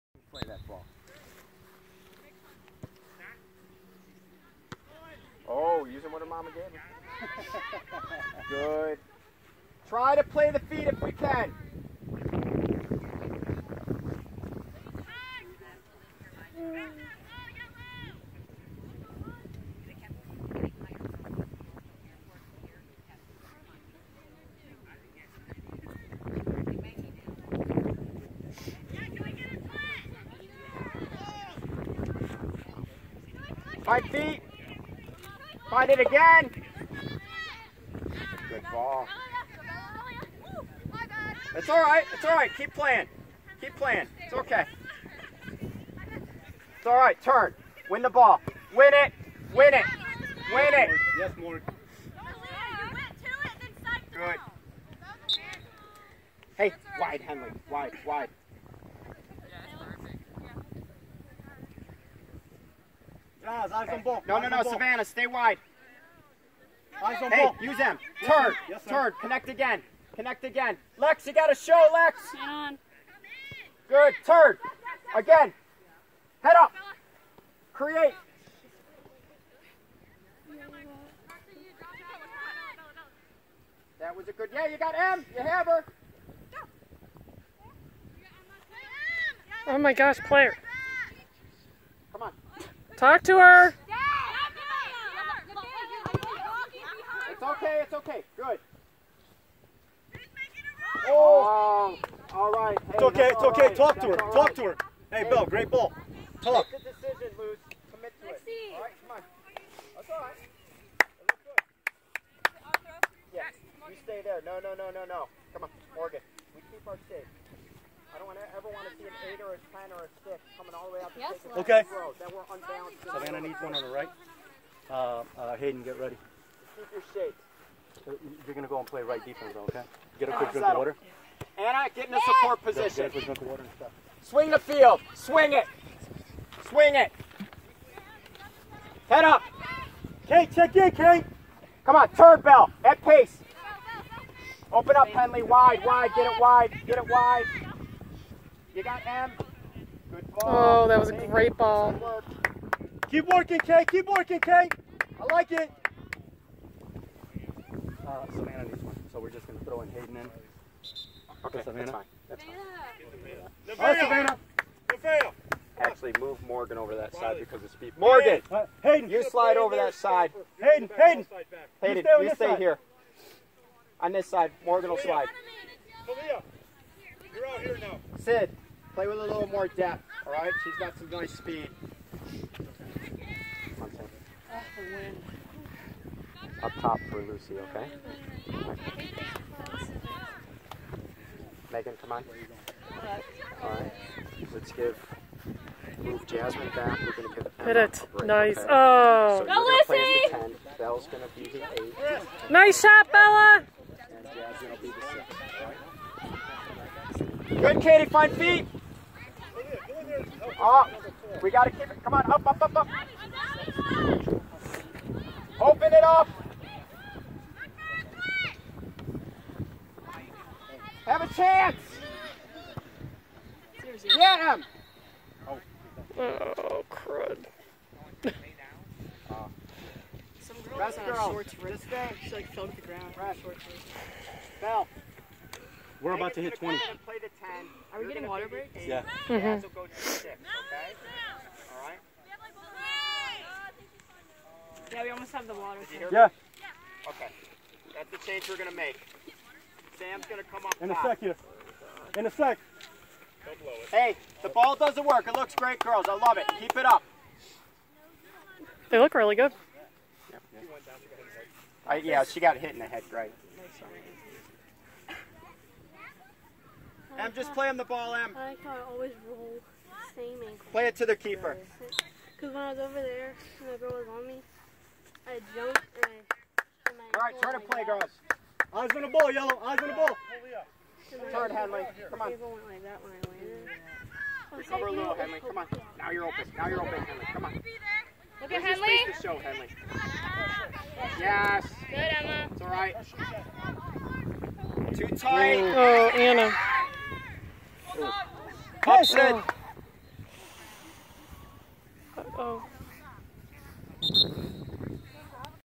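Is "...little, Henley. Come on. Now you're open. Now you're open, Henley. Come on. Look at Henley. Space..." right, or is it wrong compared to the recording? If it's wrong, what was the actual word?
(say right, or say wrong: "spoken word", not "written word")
right.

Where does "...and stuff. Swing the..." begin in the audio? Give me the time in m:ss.
2:13.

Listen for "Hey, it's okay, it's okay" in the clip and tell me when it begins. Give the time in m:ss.
1:42.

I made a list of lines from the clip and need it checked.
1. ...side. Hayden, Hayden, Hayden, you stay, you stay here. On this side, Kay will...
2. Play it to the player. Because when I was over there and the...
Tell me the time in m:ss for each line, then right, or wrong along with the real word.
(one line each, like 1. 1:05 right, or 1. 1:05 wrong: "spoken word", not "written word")
1. 2:49 wrong: "Morgan", not "Kay"
2. 4:30 wrong: "keeper", not "player".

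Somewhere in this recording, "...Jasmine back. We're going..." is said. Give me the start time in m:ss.
3:16.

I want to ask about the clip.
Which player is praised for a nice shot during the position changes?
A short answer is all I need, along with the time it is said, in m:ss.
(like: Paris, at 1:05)
Bella, at 3:22.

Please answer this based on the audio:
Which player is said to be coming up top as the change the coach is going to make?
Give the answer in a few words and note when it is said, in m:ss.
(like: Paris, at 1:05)
Sam, at 4:09.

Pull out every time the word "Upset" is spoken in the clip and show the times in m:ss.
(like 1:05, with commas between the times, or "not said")
4:58.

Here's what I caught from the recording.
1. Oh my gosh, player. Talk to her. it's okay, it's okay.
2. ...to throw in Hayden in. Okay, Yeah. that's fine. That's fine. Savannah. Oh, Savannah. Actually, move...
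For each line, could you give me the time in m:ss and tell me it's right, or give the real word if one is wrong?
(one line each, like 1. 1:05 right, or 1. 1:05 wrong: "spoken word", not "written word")
1. 1:29 right
2. 2:39 wrong: "Savannah", not "Yeah".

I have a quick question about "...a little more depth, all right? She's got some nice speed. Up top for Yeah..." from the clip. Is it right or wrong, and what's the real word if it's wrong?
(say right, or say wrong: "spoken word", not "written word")
wrong: "Lucy", not "Yeah".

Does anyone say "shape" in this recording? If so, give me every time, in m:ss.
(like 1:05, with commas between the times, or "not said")
1:57, 2:07.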